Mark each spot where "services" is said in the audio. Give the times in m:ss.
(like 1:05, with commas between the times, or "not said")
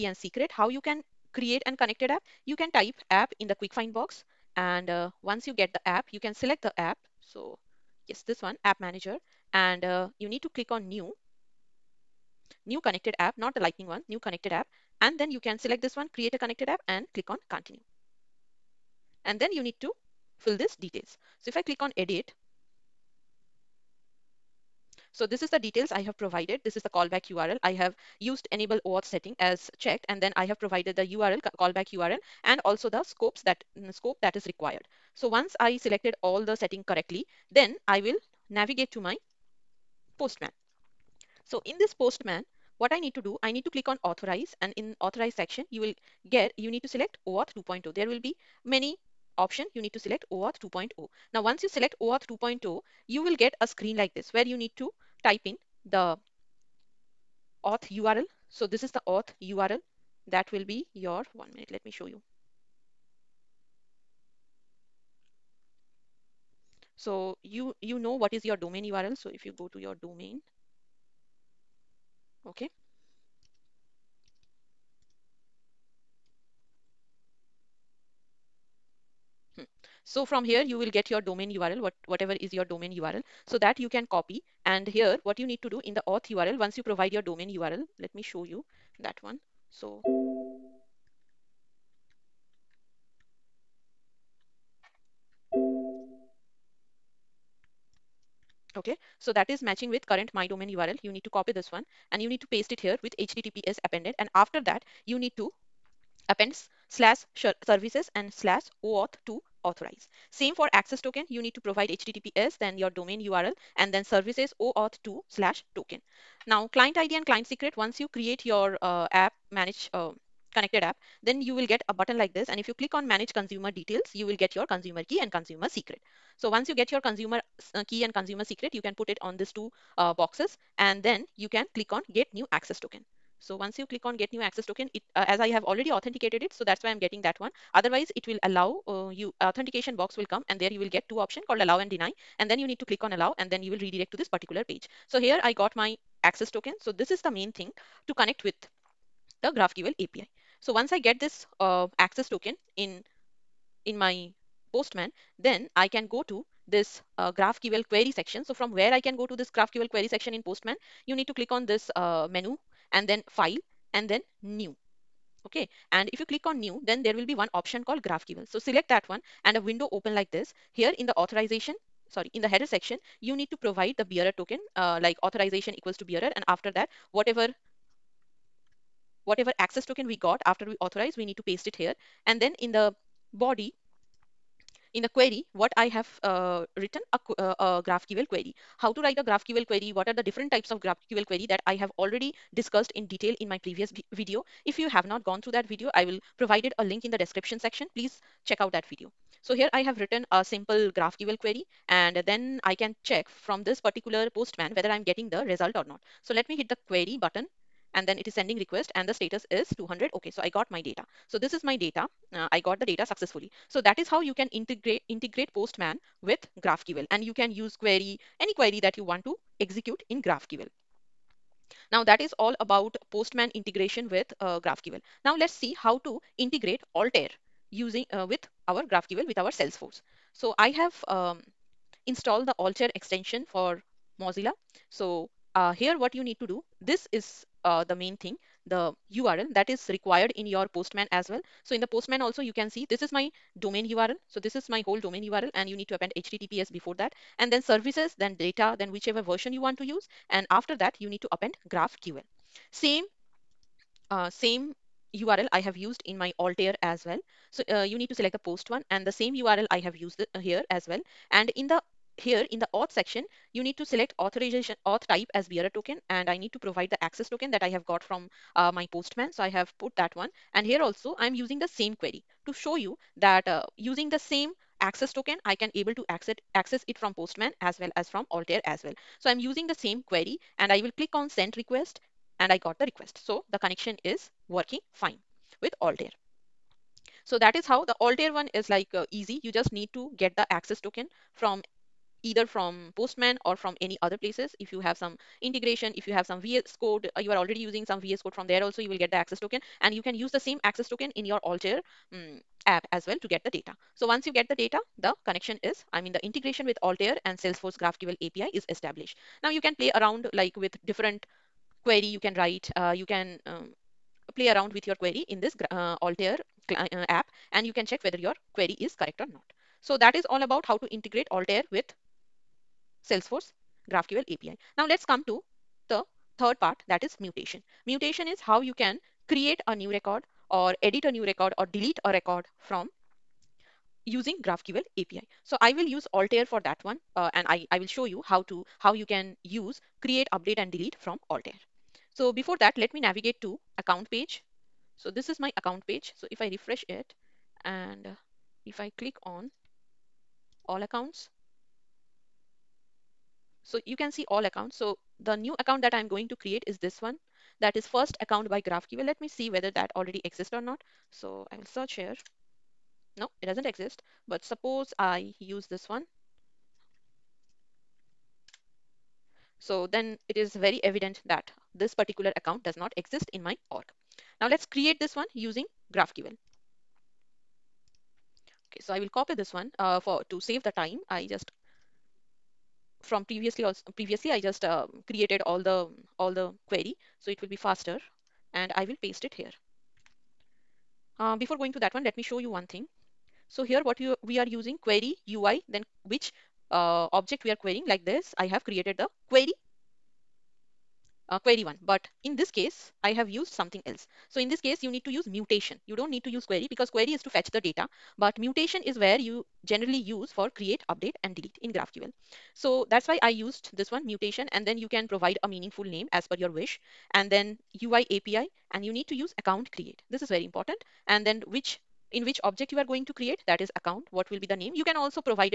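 1:47, 1:54, 4:07.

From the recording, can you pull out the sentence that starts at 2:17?
Otherwise, it will allow uh, you authentication box will come and there you will get two option called allow and deny.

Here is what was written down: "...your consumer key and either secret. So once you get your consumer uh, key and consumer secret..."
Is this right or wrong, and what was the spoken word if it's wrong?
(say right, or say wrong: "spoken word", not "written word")
wrong: "consumer", not "either".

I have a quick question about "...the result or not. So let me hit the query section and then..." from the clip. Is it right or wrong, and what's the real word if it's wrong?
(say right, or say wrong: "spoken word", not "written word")
wrong: "button", not "section".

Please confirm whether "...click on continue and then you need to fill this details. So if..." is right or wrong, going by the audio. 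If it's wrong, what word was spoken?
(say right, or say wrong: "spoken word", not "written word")
right.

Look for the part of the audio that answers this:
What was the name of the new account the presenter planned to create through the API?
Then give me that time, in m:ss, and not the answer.
5:57.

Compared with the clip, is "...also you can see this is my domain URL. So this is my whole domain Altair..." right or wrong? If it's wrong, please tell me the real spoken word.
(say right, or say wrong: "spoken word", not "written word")
wrong: "URL", not "Altair".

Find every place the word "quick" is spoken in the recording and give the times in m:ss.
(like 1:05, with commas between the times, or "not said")
0:03.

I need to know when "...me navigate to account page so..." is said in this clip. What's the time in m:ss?
5:42.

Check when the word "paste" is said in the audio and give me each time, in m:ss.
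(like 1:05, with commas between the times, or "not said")
1:42, 3:01, 6:29.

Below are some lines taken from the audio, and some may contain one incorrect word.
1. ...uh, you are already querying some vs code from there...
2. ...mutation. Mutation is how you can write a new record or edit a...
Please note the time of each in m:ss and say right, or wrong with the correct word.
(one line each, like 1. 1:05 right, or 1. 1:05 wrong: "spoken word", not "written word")
1. 4:57 wrong: "using", not "querying"
2. 5:27 wrong: "create", not "write".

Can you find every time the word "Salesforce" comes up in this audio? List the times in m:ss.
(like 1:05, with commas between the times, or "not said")
3:49, 5:07, 5:23.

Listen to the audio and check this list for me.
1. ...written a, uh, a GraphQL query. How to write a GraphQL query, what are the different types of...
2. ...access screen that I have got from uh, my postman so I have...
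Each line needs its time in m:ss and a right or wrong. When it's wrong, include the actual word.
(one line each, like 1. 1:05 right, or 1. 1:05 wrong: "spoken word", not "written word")
1. 3:06 right
2. 4:27 wrong: "token", not "screen".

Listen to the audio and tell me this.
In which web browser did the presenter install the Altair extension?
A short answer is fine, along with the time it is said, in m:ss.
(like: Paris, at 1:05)
Mozilla, at 3:54.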